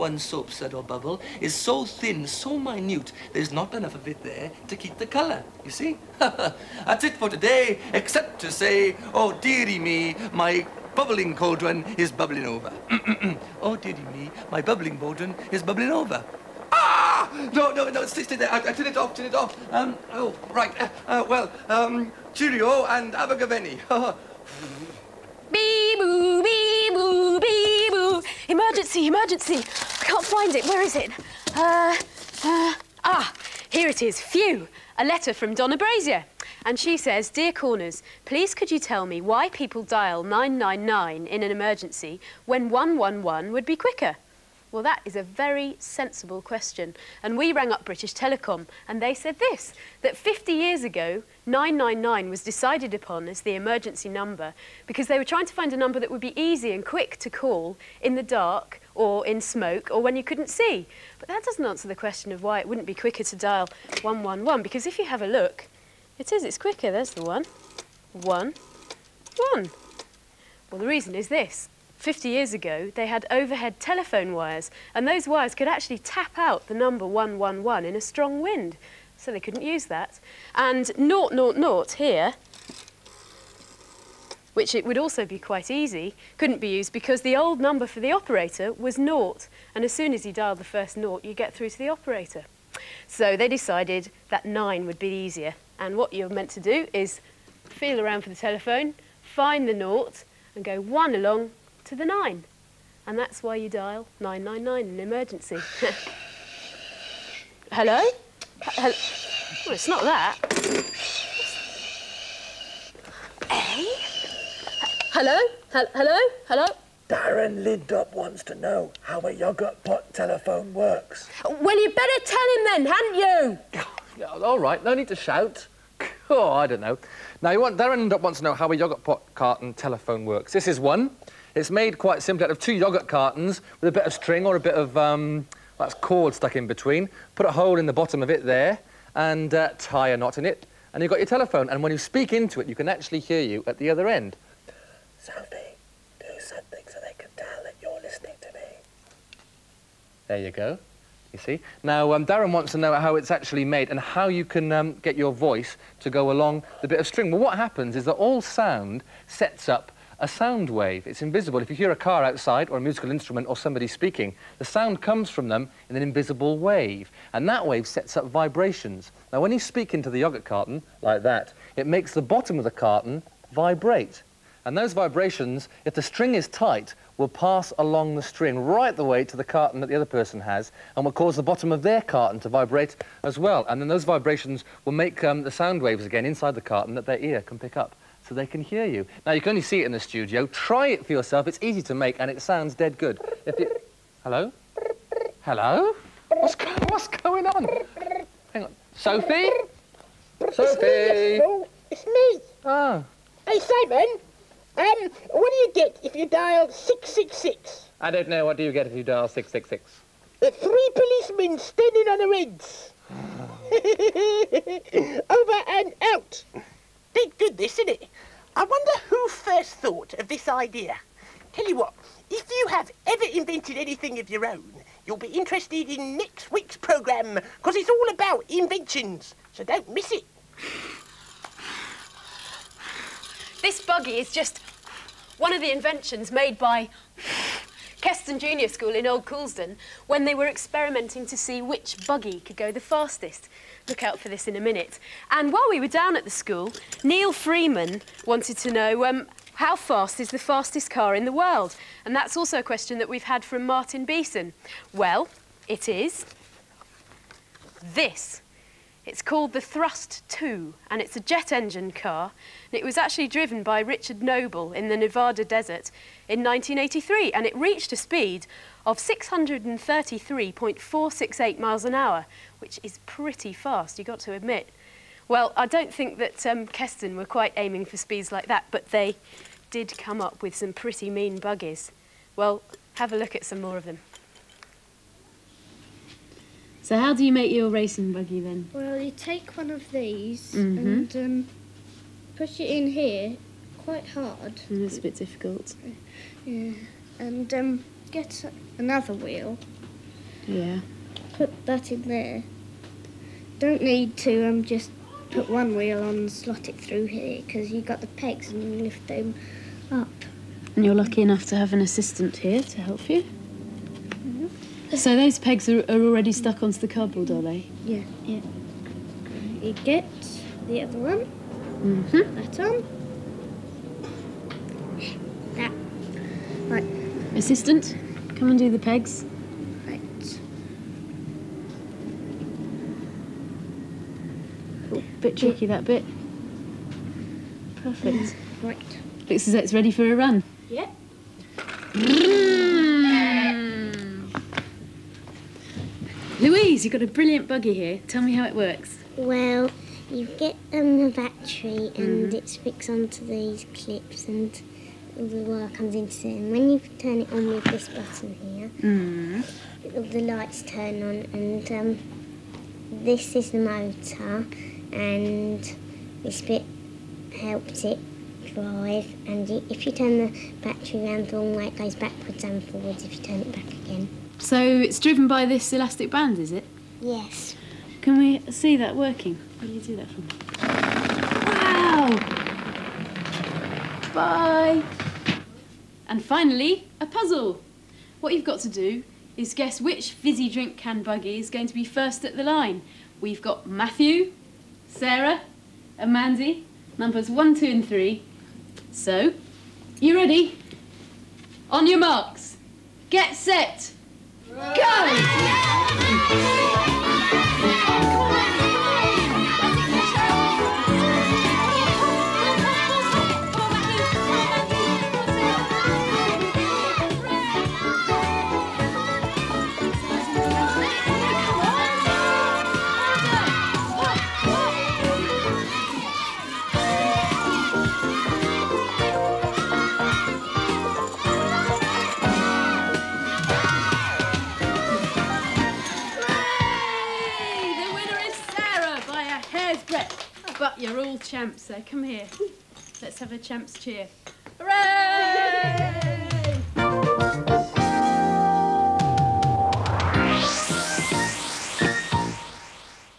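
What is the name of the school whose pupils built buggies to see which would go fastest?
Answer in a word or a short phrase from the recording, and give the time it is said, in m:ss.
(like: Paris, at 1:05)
Keston Junior School, at 3:57.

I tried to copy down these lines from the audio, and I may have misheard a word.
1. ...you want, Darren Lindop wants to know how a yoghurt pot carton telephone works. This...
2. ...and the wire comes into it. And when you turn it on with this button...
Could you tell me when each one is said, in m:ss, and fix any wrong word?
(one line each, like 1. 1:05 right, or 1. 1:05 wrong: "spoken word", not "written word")
1. 2:07 right
2. 5:54 right.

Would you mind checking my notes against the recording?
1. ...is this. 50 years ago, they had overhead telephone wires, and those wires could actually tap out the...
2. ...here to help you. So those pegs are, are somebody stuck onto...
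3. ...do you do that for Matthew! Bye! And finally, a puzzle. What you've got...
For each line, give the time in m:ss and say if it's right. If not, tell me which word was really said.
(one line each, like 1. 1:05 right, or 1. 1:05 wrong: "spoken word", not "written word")
1. 1:11 right
2. 5:12 wrong: "already", not "somebody"
3. 6:19 wrong: "Wow", not "Matthew".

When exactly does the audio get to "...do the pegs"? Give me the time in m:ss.
5:28.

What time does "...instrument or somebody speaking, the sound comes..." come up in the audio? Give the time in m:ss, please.
2:43.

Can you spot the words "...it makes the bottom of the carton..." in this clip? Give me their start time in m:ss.
2:51.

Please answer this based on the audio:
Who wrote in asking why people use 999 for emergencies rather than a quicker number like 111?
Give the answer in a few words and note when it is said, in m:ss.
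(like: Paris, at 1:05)
Donna Brazier, at 0:35.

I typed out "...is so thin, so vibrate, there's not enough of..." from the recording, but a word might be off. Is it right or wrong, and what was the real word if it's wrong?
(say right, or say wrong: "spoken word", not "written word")
wrong: "minute", not "vibrate".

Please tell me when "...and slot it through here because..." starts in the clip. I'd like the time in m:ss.
5:06.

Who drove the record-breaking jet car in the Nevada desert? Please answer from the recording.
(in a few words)
Richard Noble.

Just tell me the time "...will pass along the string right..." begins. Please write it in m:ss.
2:57.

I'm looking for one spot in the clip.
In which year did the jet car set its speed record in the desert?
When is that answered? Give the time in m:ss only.
4:26.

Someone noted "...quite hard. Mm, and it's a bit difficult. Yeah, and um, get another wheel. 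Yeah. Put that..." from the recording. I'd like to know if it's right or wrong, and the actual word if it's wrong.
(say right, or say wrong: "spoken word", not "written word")
right.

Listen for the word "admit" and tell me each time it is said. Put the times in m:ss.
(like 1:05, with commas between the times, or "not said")
4:34.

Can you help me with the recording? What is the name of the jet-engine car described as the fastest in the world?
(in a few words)
Thrust 2.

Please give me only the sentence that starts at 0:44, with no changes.
Well, that is a very sensible question.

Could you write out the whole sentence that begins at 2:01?
Well, you better tell him then, hadn't you?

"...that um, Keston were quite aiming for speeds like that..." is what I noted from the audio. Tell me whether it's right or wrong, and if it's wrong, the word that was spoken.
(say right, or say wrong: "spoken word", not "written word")
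right.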